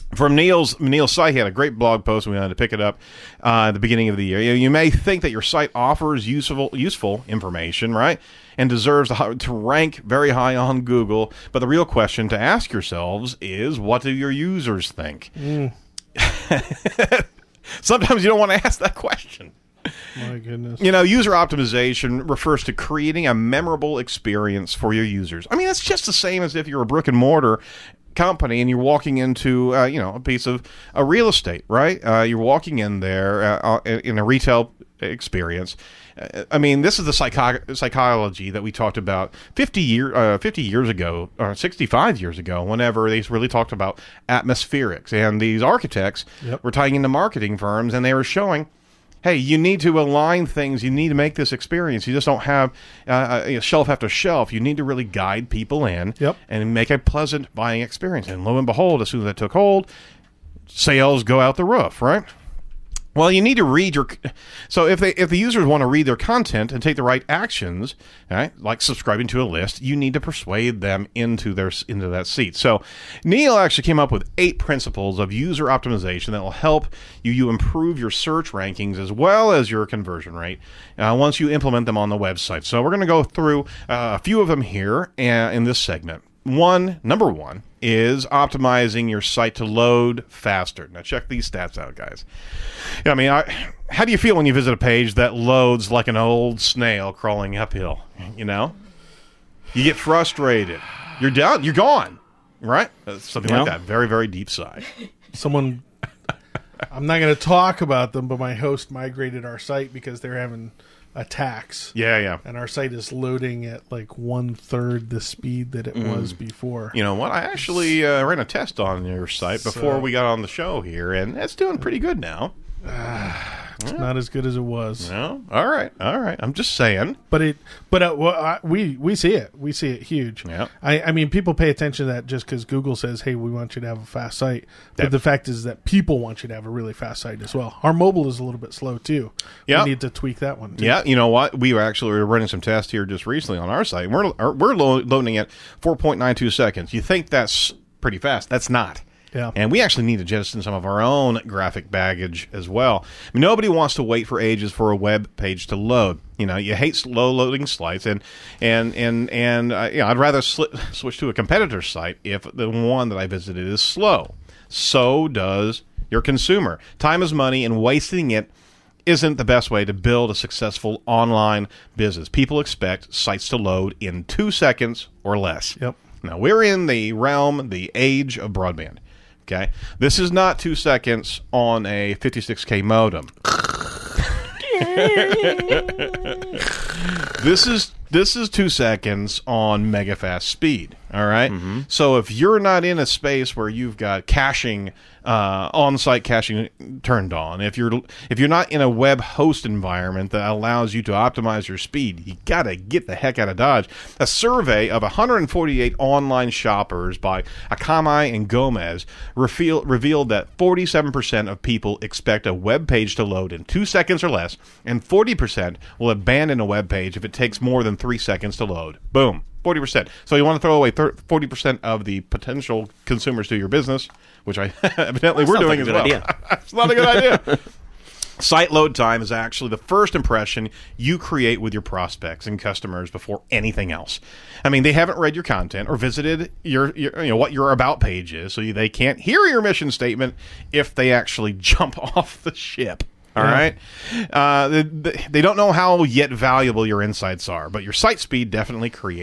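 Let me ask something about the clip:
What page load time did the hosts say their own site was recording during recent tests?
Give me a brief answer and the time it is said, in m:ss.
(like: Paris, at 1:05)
4.92 seconds, at 2:25.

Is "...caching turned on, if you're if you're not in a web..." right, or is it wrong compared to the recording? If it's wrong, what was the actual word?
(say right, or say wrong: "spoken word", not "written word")
right.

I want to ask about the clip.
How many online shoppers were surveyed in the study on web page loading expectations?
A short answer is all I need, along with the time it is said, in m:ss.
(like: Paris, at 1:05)
148, at 3:25.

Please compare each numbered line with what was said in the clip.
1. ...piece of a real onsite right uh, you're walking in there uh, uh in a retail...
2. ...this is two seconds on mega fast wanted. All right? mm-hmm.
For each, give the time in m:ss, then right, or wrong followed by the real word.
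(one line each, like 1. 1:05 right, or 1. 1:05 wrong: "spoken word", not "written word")
1. 0:30 wrong: "estate", not "onsite"
2. 3:08 wrong: "speed", not "wanted".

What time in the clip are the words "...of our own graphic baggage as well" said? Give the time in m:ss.
2:30.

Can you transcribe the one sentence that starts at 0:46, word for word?
were tying into marketing firms and they were showing hey, you need to align things.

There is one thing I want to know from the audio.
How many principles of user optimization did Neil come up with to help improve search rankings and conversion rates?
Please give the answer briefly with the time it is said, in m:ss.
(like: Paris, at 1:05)
8, at 1:14.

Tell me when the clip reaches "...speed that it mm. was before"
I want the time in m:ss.
1:55.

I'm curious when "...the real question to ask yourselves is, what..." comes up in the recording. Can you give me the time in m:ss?
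0:11.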